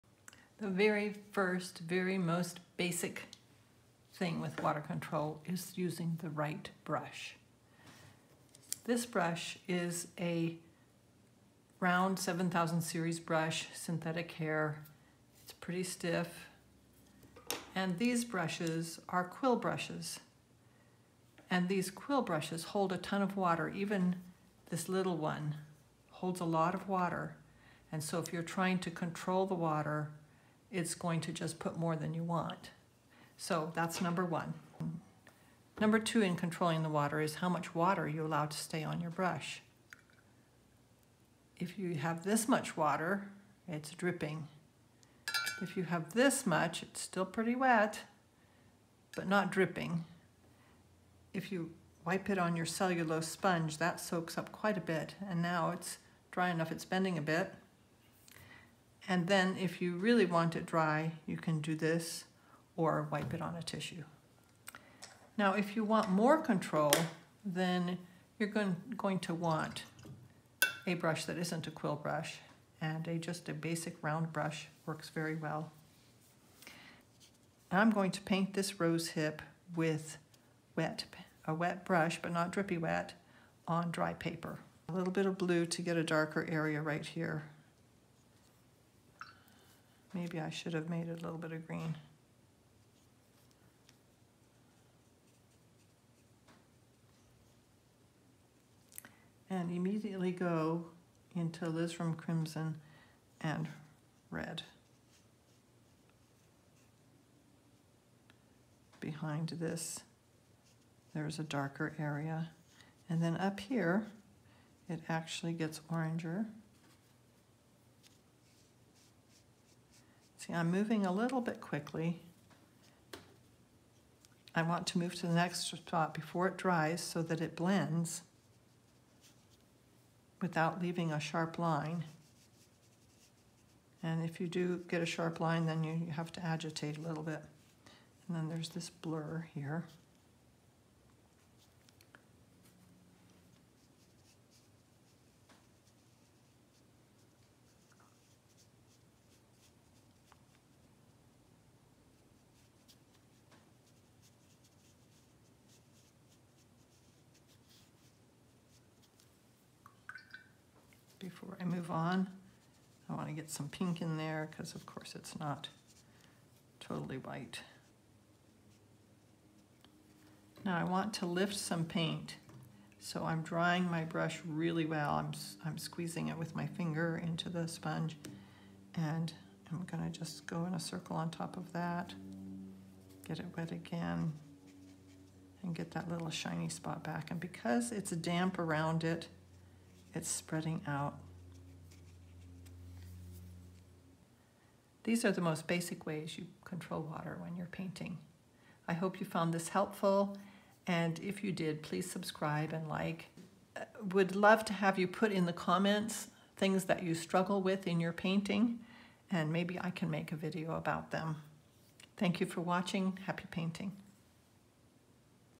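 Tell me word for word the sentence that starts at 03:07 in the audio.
And because it's damp around it, it's spreading out These are the most basic ways you control water when you're painting.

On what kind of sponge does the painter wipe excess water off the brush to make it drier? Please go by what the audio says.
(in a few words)
cellulose sponge.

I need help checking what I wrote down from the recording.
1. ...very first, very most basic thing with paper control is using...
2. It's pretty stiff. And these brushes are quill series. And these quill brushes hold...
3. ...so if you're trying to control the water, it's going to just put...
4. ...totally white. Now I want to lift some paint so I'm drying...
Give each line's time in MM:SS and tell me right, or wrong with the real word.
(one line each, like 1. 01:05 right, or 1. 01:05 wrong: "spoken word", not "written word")
1. 00:00 wrong: "water", not "paper"
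2. 00:15 wrong: "brushes", not "series"
3. 00:28 right
4. 02:46 right.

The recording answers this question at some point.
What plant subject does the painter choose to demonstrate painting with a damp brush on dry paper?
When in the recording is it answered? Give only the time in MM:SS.
01:18.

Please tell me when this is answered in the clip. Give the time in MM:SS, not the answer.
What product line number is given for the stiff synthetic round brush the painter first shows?
00:12.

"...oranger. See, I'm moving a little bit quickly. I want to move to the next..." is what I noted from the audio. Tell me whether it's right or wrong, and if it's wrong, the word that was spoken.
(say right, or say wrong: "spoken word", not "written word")
right.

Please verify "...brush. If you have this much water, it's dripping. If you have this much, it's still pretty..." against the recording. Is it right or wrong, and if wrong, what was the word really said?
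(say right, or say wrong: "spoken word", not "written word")
right.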